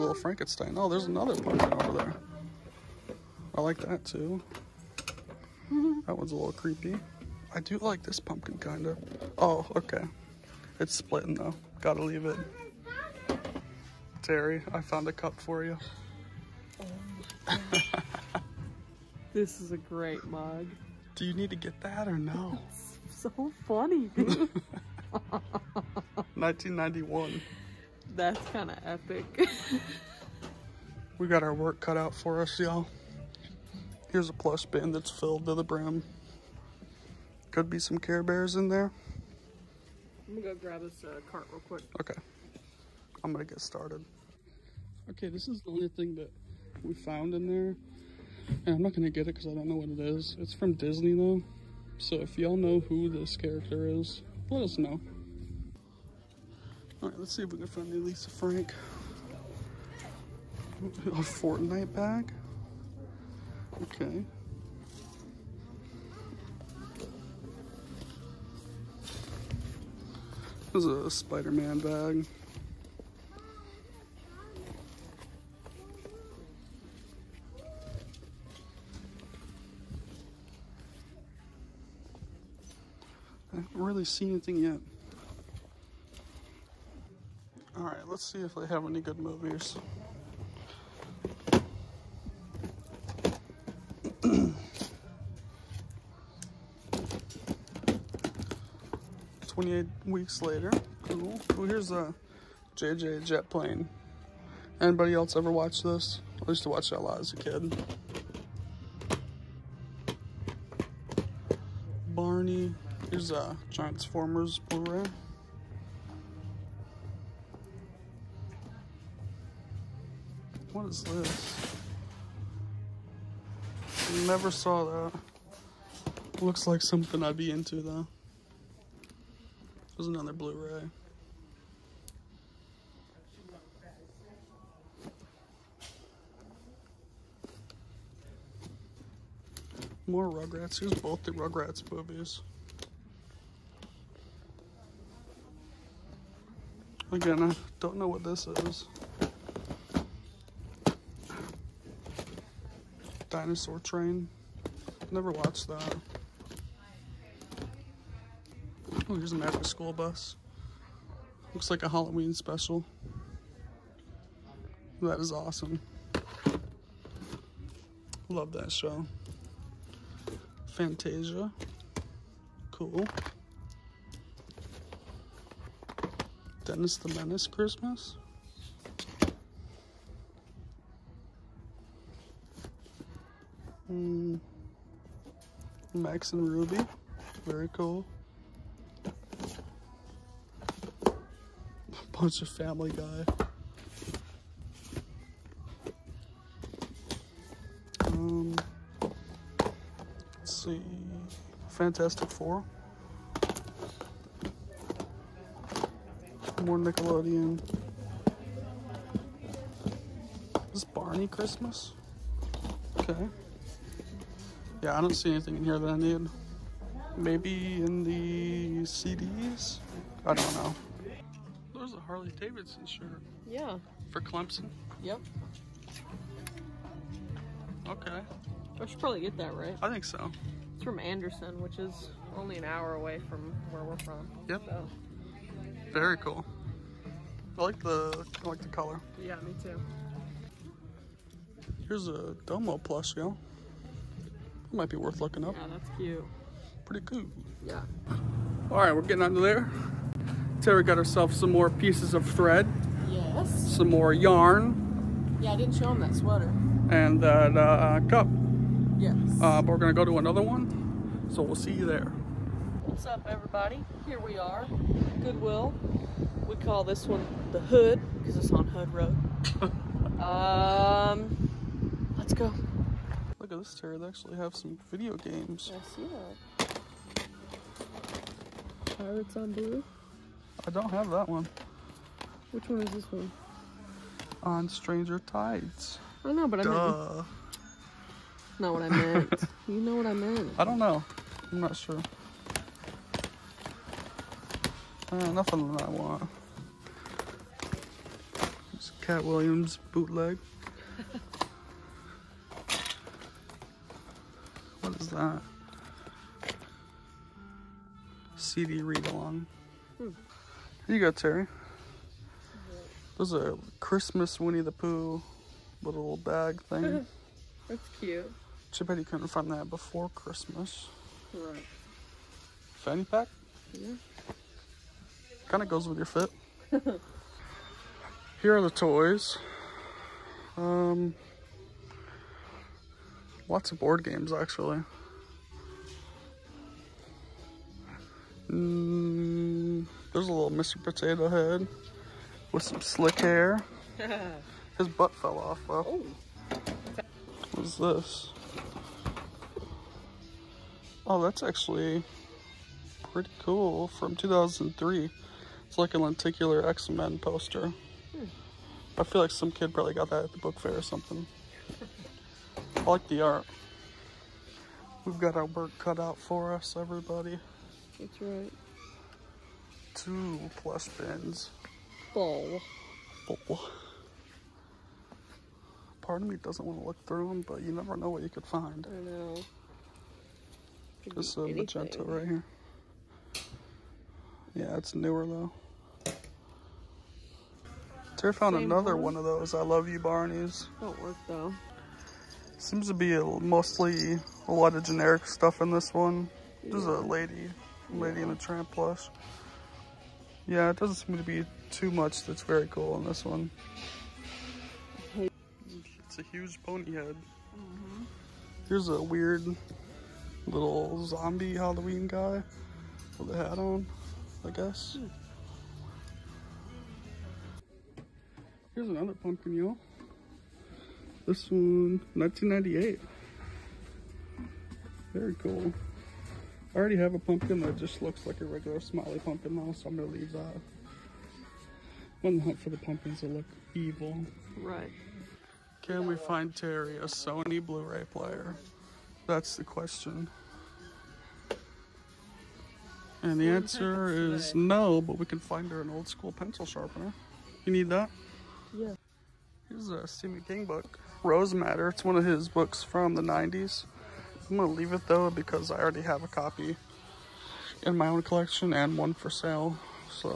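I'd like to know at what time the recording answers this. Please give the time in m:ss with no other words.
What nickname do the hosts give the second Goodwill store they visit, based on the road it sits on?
4:27.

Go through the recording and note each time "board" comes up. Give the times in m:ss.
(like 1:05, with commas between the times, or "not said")
5:33.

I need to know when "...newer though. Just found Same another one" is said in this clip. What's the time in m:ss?
6:24.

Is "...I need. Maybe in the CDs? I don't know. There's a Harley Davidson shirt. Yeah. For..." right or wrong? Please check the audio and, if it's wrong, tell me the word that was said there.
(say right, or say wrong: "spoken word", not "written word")
right.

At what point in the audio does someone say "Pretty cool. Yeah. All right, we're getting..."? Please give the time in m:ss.
4:06.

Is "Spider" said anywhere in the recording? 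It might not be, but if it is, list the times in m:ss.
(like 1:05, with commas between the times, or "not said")
1:11.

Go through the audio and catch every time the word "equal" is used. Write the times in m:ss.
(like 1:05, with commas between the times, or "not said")
not said.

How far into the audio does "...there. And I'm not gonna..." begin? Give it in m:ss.
0:47.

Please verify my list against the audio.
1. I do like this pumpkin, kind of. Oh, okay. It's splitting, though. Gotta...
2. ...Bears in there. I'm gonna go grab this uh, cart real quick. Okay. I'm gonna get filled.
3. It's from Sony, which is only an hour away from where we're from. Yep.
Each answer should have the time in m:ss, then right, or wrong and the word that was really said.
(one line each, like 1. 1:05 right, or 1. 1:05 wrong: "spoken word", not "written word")
1. 0:07 right
2. 0:38 wrong: "started", not "filled"
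3. 3:50 wrong: "Anderson", not "Sony".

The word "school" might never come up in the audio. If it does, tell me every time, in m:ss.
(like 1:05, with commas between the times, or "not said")
2:39, 7:26.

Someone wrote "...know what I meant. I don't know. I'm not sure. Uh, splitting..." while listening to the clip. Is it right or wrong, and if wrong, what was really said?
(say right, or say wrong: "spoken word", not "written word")
wrong: "nothing", not "splitting".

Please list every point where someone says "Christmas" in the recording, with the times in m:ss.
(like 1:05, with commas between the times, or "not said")
2:57, 3:31, 5:13, 5:20.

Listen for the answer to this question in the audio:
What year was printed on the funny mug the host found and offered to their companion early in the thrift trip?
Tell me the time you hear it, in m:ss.
0:26.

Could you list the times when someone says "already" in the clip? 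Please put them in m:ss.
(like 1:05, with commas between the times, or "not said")
7:06, 7:35.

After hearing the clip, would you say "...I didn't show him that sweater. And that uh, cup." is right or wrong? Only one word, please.
right.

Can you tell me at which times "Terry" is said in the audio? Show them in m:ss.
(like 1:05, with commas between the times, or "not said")
0:14, 5:11, 7:16.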